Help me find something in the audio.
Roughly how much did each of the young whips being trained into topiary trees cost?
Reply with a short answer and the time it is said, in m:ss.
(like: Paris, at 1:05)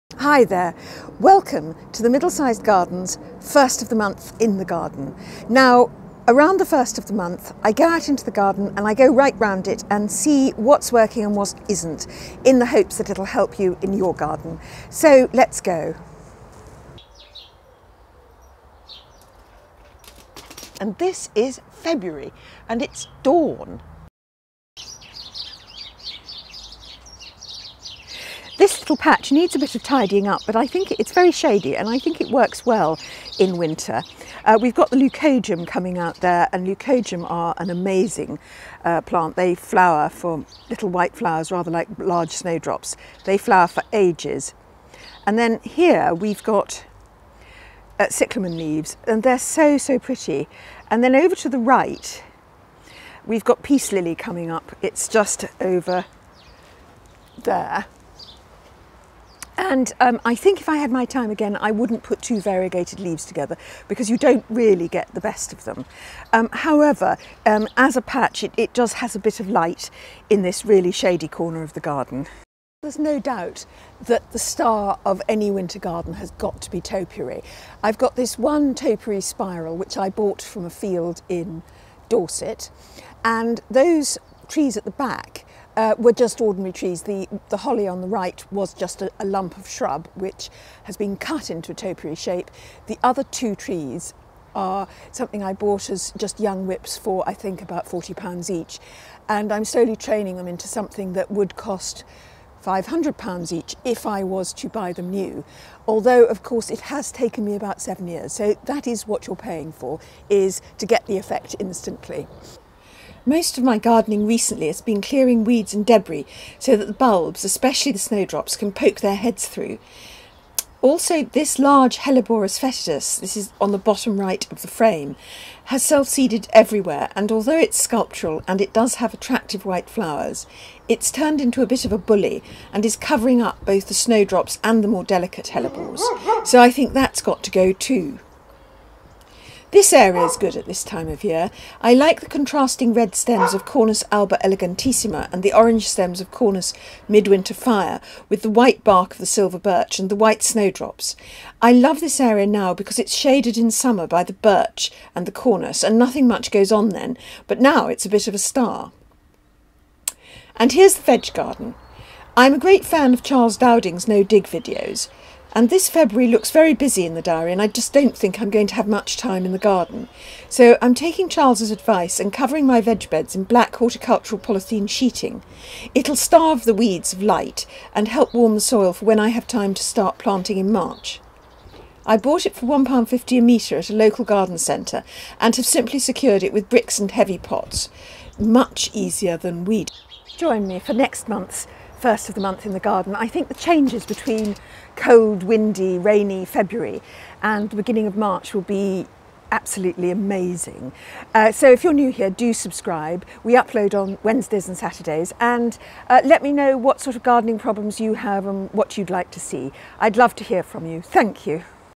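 £40, at 1:37.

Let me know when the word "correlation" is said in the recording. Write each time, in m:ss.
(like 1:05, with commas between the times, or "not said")
not said.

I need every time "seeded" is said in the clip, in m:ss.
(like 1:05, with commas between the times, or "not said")
2:05.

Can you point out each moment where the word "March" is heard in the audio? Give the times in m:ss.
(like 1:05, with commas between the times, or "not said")
3:00, 3:18.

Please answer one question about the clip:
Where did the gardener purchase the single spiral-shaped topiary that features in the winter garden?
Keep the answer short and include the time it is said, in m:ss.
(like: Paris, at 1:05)
A field in Dorset, at 1:20.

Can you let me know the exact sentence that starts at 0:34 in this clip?
Uh, we've got the leucojum coming out there and leucojum are an amazing uh, plant.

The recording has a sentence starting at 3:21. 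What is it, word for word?
Uh, so if you're new here, do subscribe.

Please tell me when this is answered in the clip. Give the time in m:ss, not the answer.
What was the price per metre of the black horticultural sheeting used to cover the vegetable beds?
3:02.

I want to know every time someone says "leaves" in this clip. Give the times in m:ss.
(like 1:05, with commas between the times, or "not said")
0:48, 1:02.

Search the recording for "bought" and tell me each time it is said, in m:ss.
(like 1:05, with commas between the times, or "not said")
1:20, 1:35, 3:02.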